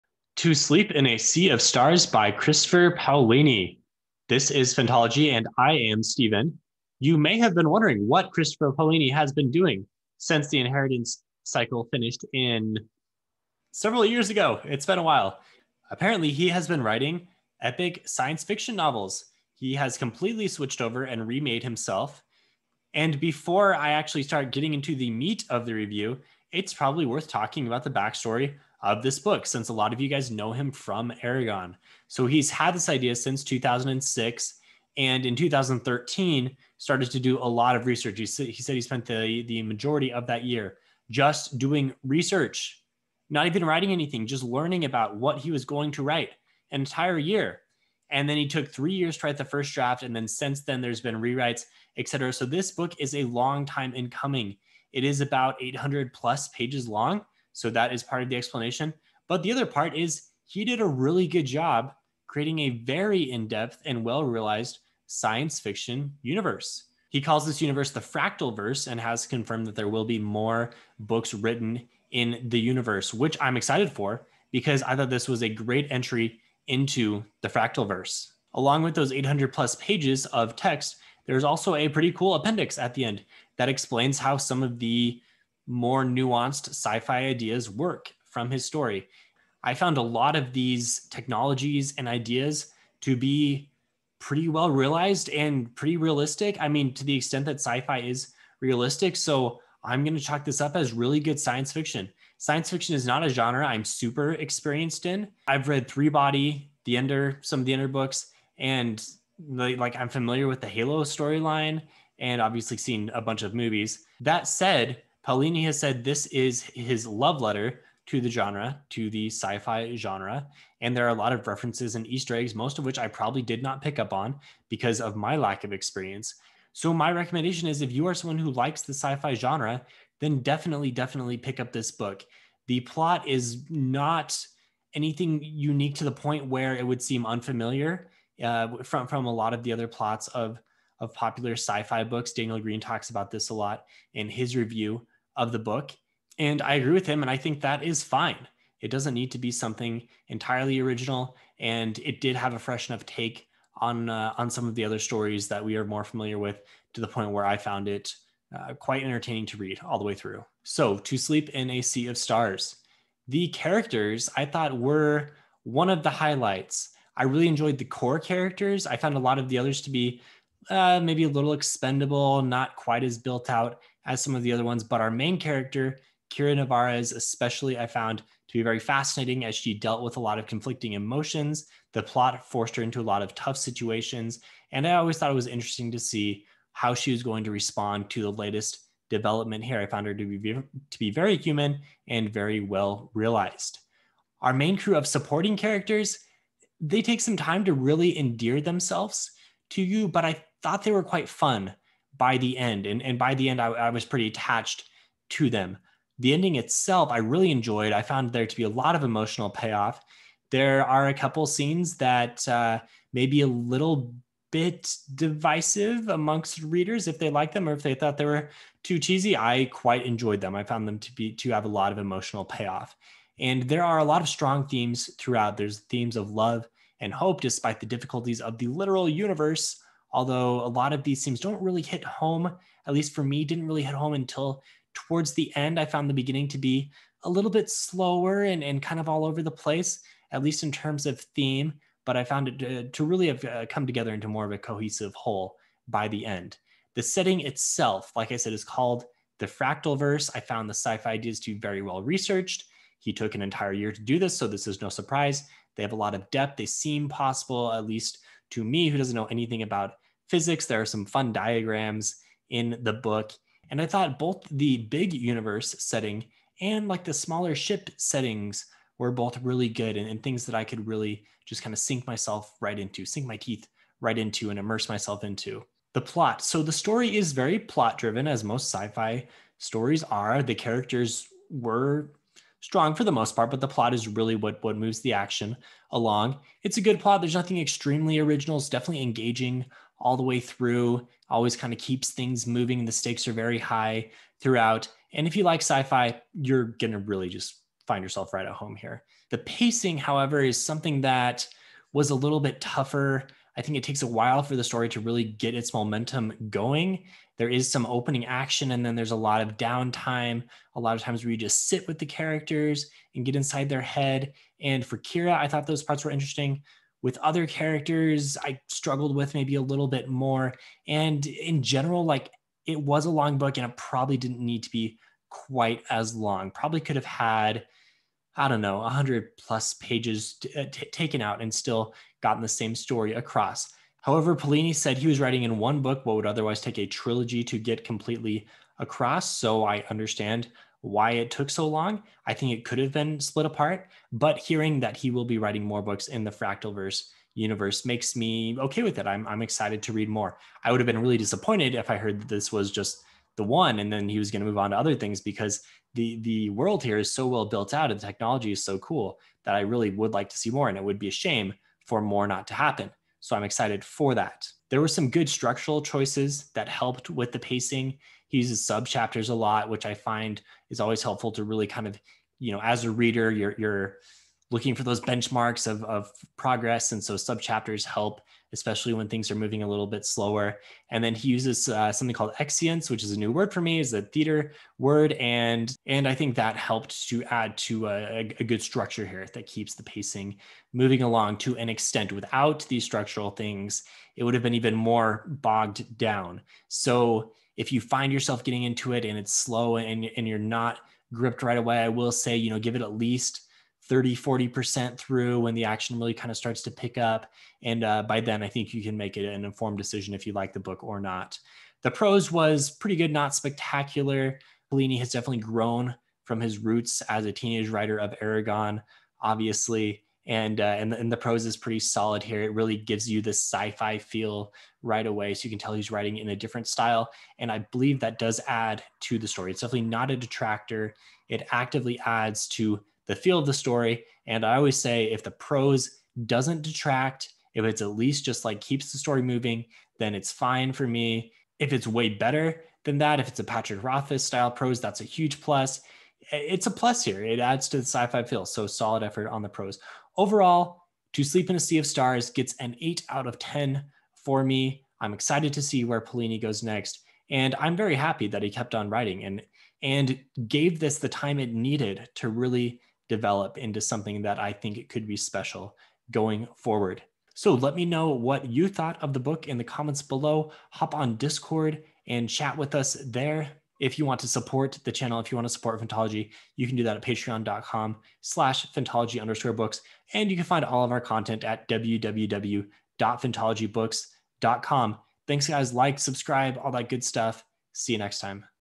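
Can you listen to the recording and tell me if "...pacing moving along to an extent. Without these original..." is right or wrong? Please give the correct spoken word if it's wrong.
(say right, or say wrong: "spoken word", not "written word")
wrong: "structural", not "original".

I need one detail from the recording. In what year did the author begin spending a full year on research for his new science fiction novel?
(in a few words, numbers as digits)
2013.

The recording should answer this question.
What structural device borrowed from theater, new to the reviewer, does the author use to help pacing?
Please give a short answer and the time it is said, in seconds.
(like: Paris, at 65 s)
Excience, at 382 s.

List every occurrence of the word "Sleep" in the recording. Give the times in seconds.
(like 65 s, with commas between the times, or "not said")
0 s, 161 s, 451 s.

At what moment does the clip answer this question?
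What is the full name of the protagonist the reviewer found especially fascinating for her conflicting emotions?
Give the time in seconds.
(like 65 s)
176 s.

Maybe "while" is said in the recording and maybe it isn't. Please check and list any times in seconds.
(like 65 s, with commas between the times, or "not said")
15 s, 304 s.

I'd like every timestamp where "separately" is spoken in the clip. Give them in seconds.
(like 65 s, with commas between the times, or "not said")
not said.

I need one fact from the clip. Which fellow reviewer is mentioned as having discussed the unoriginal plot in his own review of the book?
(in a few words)
Daniel Greene.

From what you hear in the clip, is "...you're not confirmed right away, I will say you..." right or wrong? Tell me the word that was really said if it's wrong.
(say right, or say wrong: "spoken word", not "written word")
wrong: "gripped", not "confirmed".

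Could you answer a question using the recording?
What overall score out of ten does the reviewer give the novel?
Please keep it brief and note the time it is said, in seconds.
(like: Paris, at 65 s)
8, at 452 s.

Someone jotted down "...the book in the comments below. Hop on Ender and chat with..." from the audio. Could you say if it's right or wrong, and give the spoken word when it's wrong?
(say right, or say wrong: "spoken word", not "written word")
wrong: "Discord", not "Ender".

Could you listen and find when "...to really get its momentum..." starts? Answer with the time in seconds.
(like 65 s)
304 s.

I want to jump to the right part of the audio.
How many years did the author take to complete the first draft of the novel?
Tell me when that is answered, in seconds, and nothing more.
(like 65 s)
48 s.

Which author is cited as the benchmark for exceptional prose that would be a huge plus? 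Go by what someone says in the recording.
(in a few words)
Patrick Rothfuss.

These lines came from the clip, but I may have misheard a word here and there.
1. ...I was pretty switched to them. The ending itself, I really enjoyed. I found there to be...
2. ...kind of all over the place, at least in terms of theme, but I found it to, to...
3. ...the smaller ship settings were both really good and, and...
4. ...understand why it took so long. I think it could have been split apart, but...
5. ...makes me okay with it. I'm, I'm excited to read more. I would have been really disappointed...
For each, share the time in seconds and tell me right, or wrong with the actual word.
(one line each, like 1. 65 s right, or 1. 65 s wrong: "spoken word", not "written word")
1. 203 s wrong: "attached", not "switched"
2. 238 s right
3. 267 s right
4. 339 s right
5. 347 s right.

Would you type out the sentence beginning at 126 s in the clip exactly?
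So, my recommendation is if you are someone who likes the sci fi genre, then definitely, definitely pick up this book.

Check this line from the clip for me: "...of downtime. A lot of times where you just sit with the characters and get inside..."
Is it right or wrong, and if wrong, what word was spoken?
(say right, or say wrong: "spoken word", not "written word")
right.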